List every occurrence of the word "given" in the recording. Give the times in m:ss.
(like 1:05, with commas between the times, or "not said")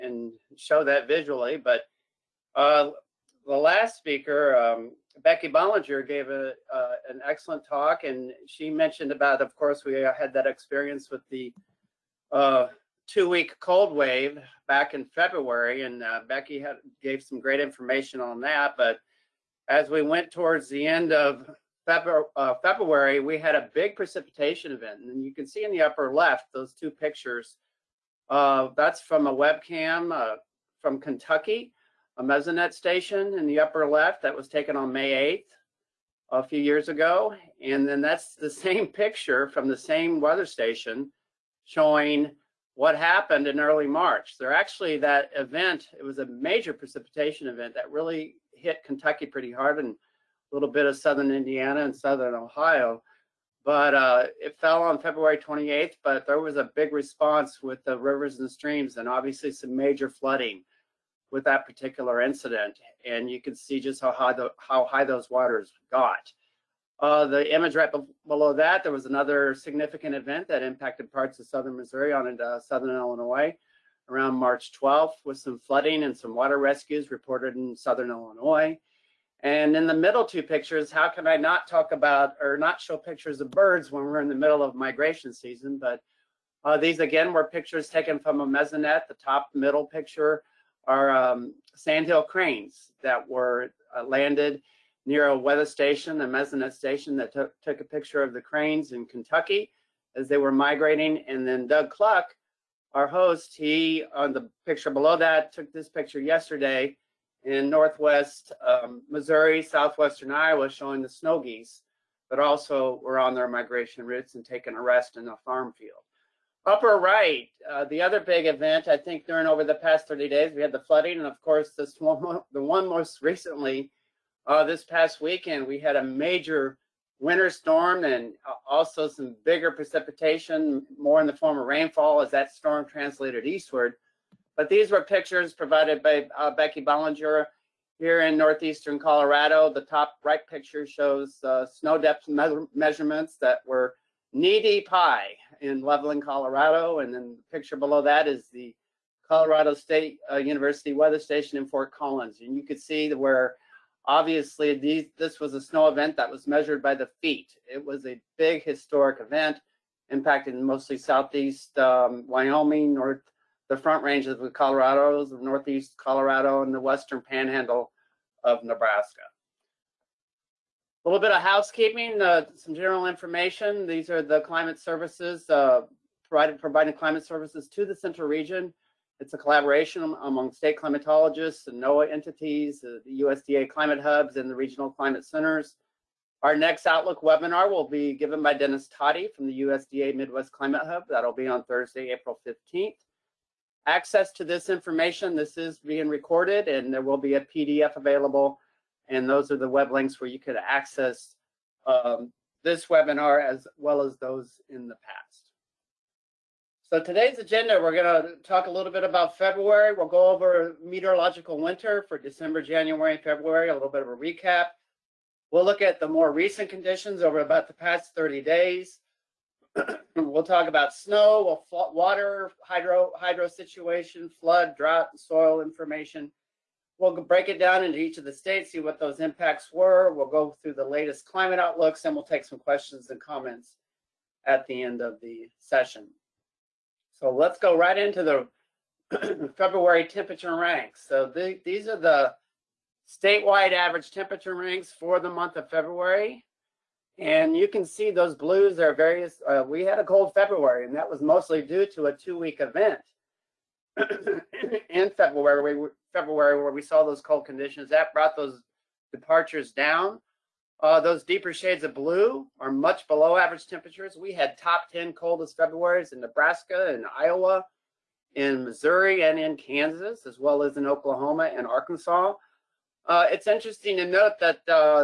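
3:08.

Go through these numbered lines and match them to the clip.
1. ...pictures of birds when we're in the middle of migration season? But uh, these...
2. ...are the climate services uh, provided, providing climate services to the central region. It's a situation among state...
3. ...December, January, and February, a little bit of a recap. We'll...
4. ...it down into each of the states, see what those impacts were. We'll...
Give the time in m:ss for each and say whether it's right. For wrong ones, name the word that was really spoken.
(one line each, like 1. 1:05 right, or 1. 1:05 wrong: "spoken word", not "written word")
1. 1:22 right
2. 2:54 wrong: "collaboration", not "situation"
3. 3:32 right
4. 3:47 right.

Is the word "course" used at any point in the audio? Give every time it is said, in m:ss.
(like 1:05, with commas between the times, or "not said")
0:09, 2:01.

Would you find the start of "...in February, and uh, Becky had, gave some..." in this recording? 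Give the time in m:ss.
0:14.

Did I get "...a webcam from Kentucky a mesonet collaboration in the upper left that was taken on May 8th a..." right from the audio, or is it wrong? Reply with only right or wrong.
wrong.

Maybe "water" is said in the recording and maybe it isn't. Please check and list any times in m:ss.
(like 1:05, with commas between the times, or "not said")
1:05, 1:16, 3:41.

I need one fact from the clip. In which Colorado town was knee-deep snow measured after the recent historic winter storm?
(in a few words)
Loveland.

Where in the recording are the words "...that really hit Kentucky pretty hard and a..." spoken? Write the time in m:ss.
0:47.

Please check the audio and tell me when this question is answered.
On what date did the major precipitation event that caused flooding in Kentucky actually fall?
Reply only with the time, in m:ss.
0:54.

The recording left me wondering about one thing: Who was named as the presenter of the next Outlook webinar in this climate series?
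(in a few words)
Dennis Todey.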